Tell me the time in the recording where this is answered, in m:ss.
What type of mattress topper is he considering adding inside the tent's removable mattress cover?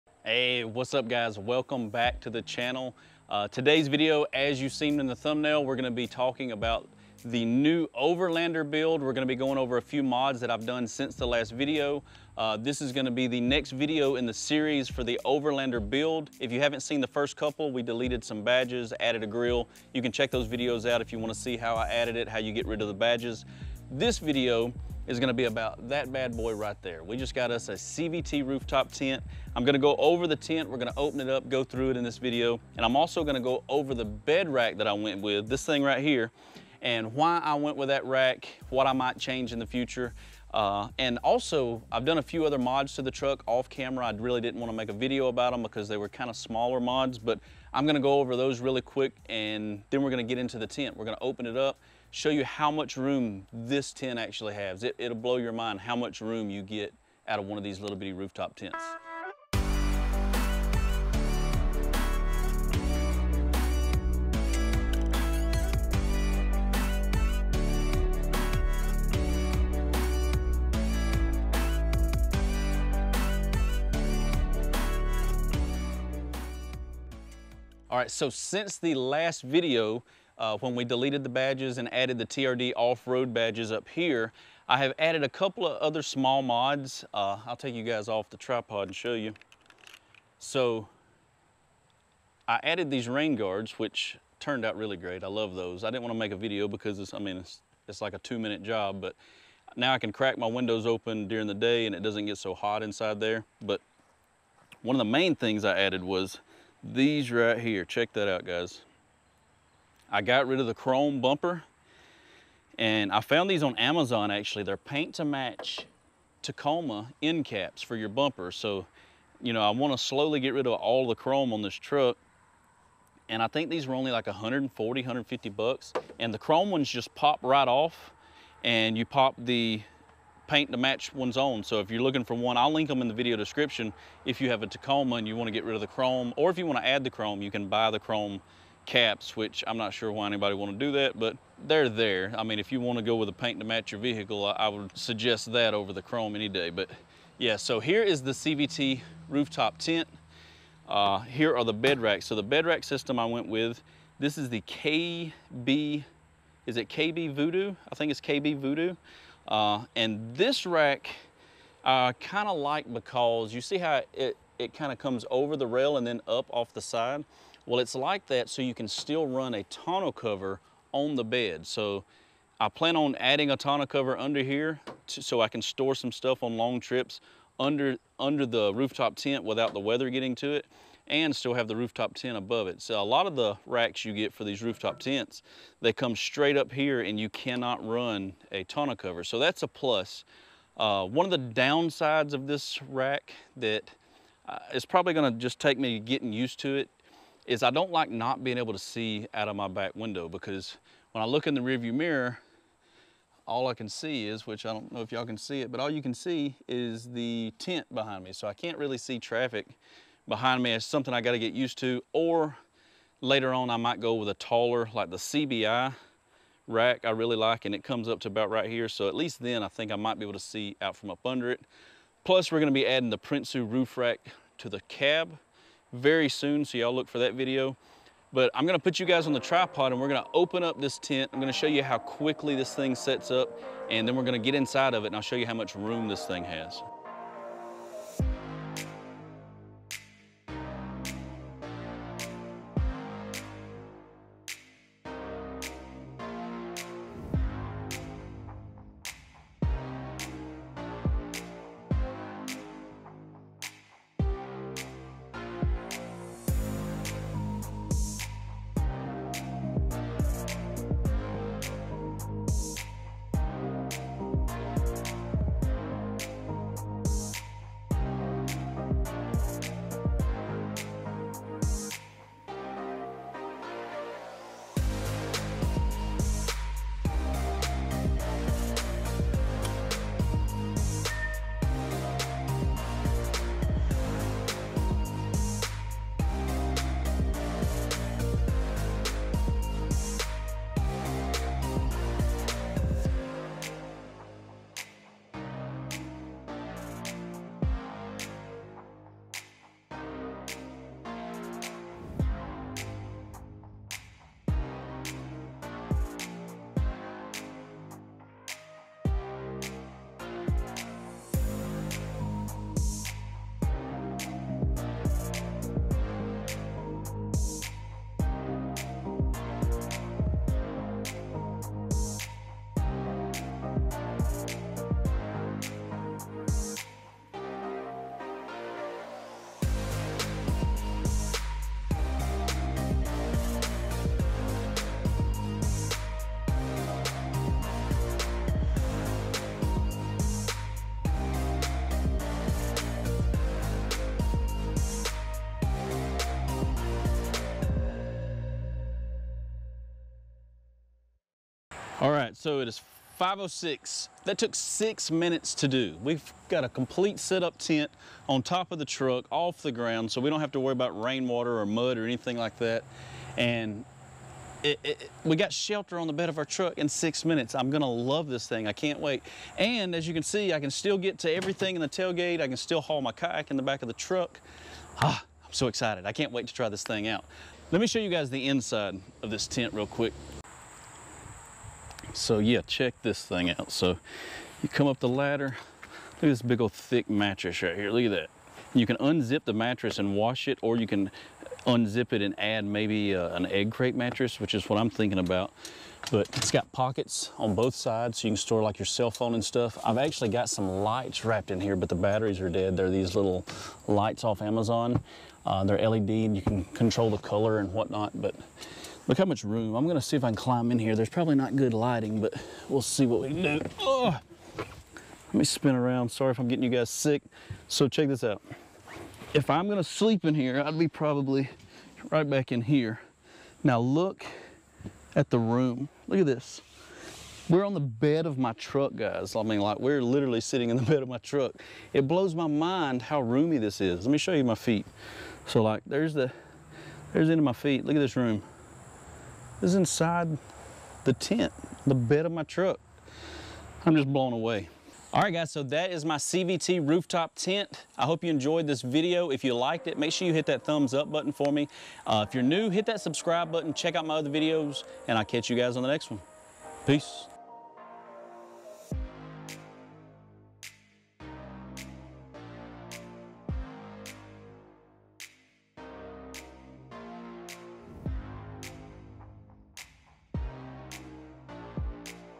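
6:33.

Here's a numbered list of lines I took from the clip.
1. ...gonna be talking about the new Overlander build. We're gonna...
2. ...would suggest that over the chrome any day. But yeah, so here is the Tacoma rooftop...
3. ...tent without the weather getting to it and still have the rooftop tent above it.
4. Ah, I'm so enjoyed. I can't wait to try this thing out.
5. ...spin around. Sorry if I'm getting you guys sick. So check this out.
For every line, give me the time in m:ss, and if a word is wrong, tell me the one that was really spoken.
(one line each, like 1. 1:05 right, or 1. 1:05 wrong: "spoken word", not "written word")
1. 0:05 right
2. 2:24 wrong: "CVT", not "Tacoma"
3. 2:59 right
4. 6:15 wrong: "excited", not "enjoyed"
5. 6:55 right.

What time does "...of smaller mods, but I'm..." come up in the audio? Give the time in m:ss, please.
0:46.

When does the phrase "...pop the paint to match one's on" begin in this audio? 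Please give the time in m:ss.
2:09.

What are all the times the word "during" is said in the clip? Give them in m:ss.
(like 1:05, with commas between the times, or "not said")
1:41.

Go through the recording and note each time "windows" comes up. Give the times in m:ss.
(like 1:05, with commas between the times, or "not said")
1:40, 3:19.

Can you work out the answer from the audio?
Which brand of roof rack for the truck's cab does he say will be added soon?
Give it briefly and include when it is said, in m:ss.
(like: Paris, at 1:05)
Prinsu, at 3:43.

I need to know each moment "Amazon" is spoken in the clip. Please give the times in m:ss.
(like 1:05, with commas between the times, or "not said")
1:53, 6:44.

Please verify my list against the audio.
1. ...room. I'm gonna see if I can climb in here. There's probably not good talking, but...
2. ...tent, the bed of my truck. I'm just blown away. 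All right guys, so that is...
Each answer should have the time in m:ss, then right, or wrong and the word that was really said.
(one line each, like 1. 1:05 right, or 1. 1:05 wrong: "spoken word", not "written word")
1. 6:49 wrong: "lighting", not "talking"
2. 7:21 right.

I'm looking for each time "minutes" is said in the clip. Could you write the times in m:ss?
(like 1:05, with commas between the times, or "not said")
1:38, 5:55, 6:07.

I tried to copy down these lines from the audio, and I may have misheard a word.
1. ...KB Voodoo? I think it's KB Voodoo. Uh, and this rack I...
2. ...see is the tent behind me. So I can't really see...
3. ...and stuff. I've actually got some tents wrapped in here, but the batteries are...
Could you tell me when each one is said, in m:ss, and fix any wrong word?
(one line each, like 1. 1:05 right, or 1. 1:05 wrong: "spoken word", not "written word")
1. 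2:36 right
2. 3:26 right
3. 6:39 wrong: "lights", not "tents".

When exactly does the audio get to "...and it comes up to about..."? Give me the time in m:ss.
3:37.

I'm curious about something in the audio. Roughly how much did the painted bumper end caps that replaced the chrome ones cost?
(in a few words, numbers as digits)
$140-150.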